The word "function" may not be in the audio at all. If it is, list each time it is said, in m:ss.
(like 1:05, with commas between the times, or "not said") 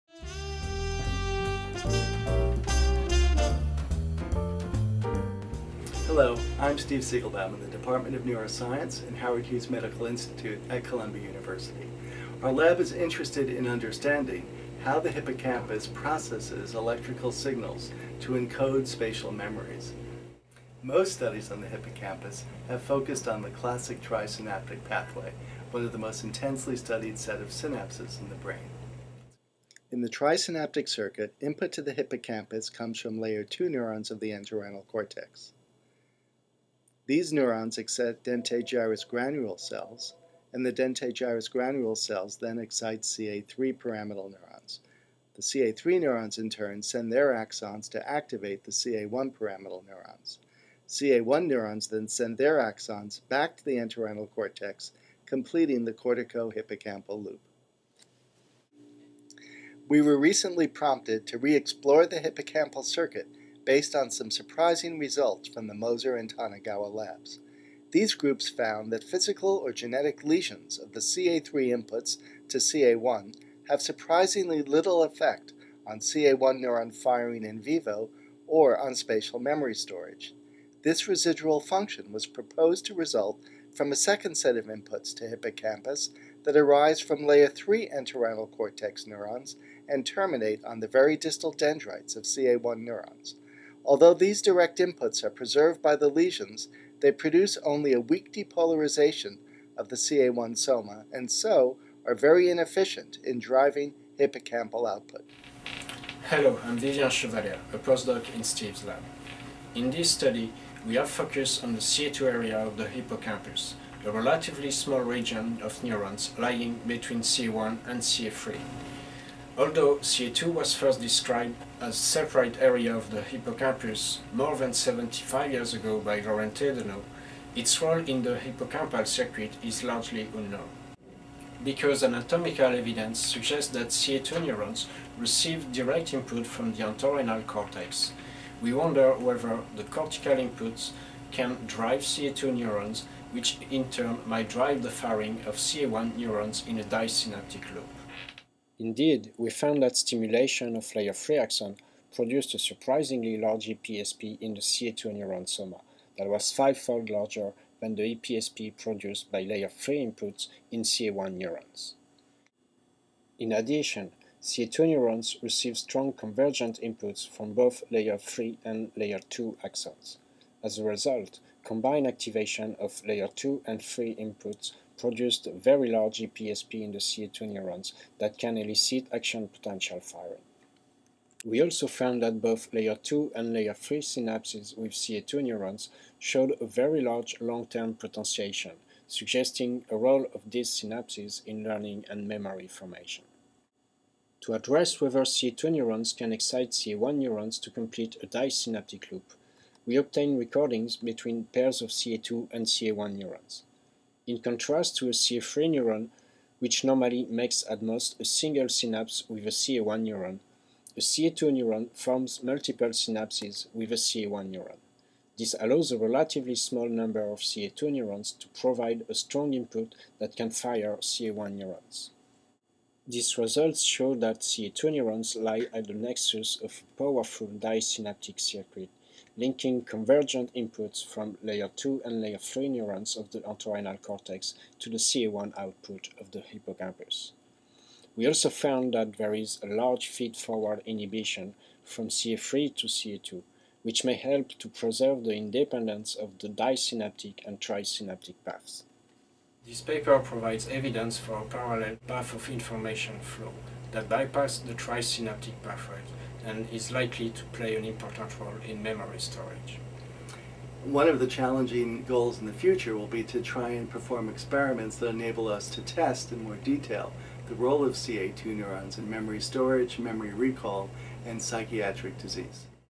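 1:21.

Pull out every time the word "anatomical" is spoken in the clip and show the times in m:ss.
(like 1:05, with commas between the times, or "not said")
2:12.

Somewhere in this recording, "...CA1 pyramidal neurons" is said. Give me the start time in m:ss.
0:48.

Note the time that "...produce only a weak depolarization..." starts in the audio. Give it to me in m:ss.
1:37.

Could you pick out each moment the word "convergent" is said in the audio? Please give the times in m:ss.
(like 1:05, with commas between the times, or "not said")
2:46, 3:49.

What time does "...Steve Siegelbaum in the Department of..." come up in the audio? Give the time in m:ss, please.
0:06.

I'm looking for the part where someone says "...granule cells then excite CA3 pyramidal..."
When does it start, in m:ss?
0:41.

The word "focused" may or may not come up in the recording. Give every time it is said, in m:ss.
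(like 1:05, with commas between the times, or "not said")
0:22, 1:51.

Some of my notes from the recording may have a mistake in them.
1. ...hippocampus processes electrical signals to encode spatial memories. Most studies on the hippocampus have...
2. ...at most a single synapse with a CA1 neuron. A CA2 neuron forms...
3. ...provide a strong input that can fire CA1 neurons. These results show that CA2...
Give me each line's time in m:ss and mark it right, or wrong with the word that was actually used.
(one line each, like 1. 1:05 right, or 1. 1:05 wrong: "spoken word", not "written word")
1. 0:15 right
2. 3:27 right
3. 3:38 right.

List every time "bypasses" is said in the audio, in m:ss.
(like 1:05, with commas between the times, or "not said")
4:14.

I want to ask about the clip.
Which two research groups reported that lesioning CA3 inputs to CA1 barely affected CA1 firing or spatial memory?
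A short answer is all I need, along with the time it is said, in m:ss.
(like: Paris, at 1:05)
Moser and Tonegawa, at 1:05.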